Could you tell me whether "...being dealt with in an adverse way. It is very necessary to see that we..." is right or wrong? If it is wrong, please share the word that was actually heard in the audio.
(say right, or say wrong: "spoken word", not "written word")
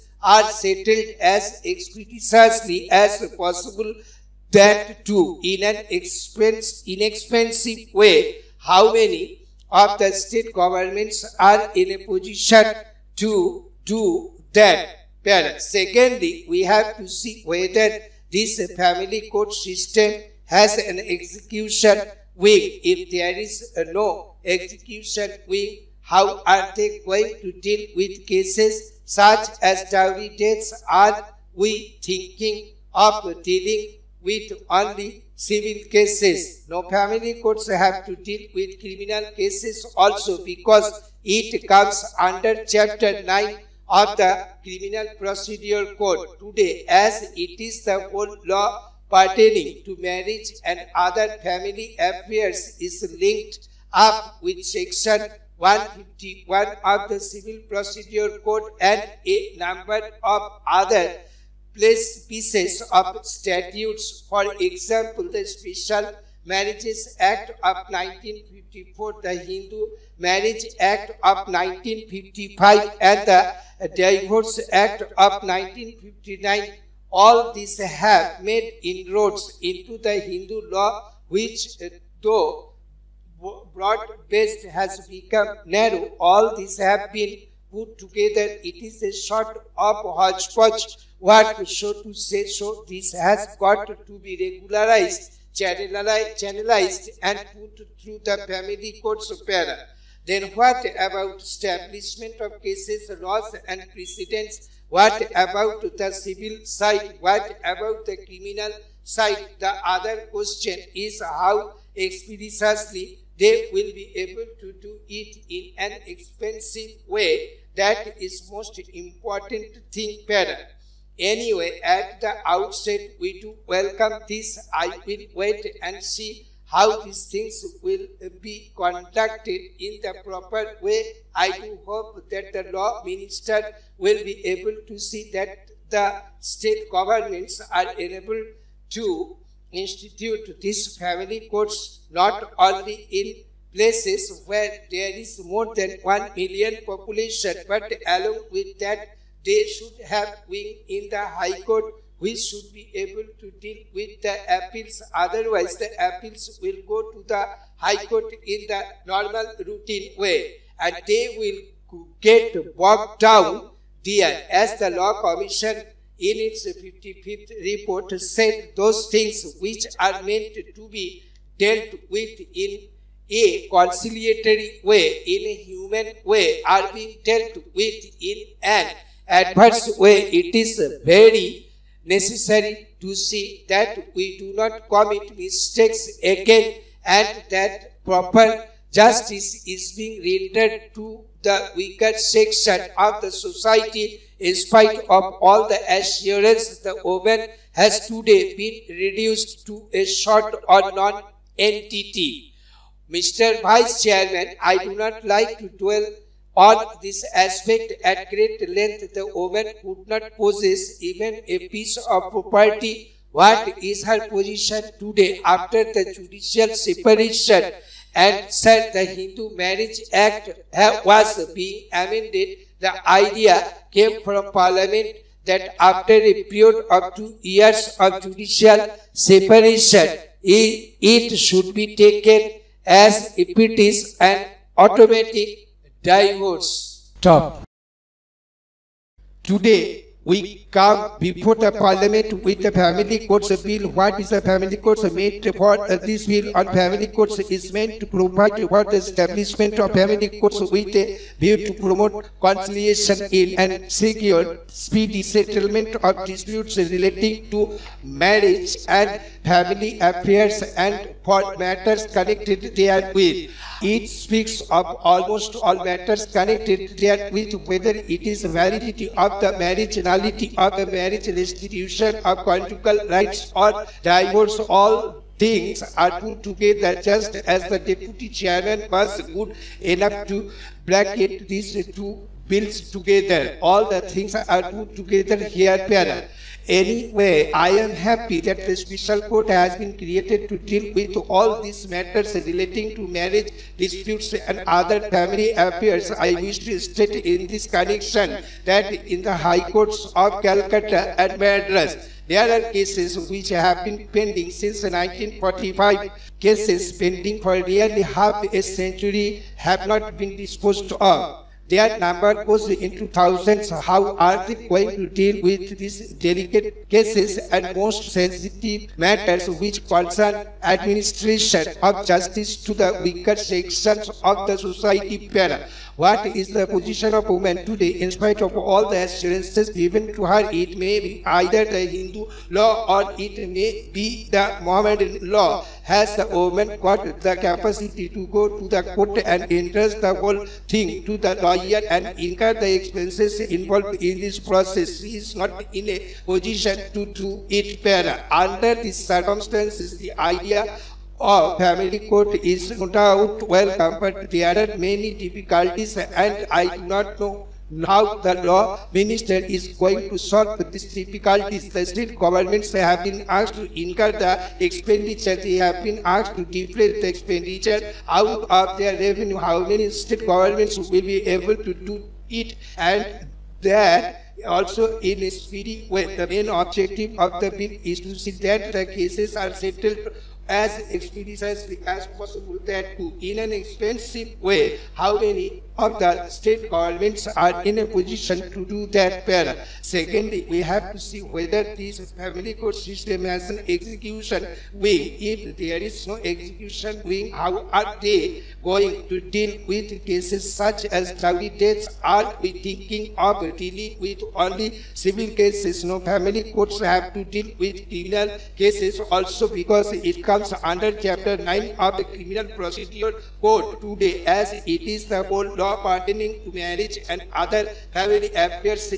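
right.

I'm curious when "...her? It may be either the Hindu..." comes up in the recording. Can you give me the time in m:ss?
5:30.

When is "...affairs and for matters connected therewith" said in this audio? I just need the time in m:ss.
4:19.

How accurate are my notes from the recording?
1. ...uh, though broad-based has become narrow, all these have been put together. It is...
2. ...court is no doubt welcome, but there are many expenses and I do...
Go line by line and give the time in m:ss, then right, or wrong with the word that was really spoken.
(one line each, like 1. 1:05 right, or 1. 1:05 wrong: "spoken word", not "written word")
1. 1:21 right
2. 5:52 wrong: "difficulties", not "expenses".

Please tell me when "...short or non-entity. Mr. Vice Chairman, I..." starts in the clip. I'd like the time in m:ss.
3:20.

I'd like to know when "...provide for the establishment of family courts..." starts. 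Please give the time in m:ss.
4:08.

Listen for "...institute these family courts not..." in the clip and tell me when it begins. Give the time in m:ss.
2:19.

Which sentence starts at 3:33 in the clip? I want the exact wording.
What is her position today after the judicial separation?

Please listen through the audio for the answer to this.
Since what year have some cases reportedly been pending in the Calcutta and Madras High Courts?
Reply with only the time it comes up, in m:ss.
5:04.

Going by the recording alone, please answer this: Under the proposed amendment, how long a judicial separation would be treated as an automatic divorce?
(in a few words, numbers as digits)
2 years.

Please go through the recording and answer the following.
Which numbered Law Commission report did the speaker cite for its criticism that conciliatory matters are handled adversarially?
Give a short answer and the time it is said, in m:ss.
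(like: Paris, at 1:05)
55th, at 2:46.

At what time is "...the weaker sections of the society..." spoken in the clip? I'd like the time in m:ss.
5:22.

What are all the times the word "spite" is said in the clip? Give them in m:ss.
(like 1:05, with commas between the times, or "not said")
3:14, 5:28.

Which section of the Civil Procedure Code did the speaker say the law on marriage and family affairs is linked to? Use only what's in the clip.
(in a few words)
Section 151.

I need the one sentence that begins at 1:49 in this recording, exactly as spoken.
The other question is how expeditiously they will be able to do it in an expensive way.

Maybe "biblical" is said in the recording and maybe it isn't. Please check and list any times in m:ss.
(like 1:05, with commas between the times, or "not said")
not said.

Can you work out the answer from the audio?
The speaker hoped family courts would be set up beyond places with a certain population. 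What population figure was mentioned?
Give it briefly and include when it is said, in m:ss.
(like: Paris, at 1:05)
1 million, at 2:26.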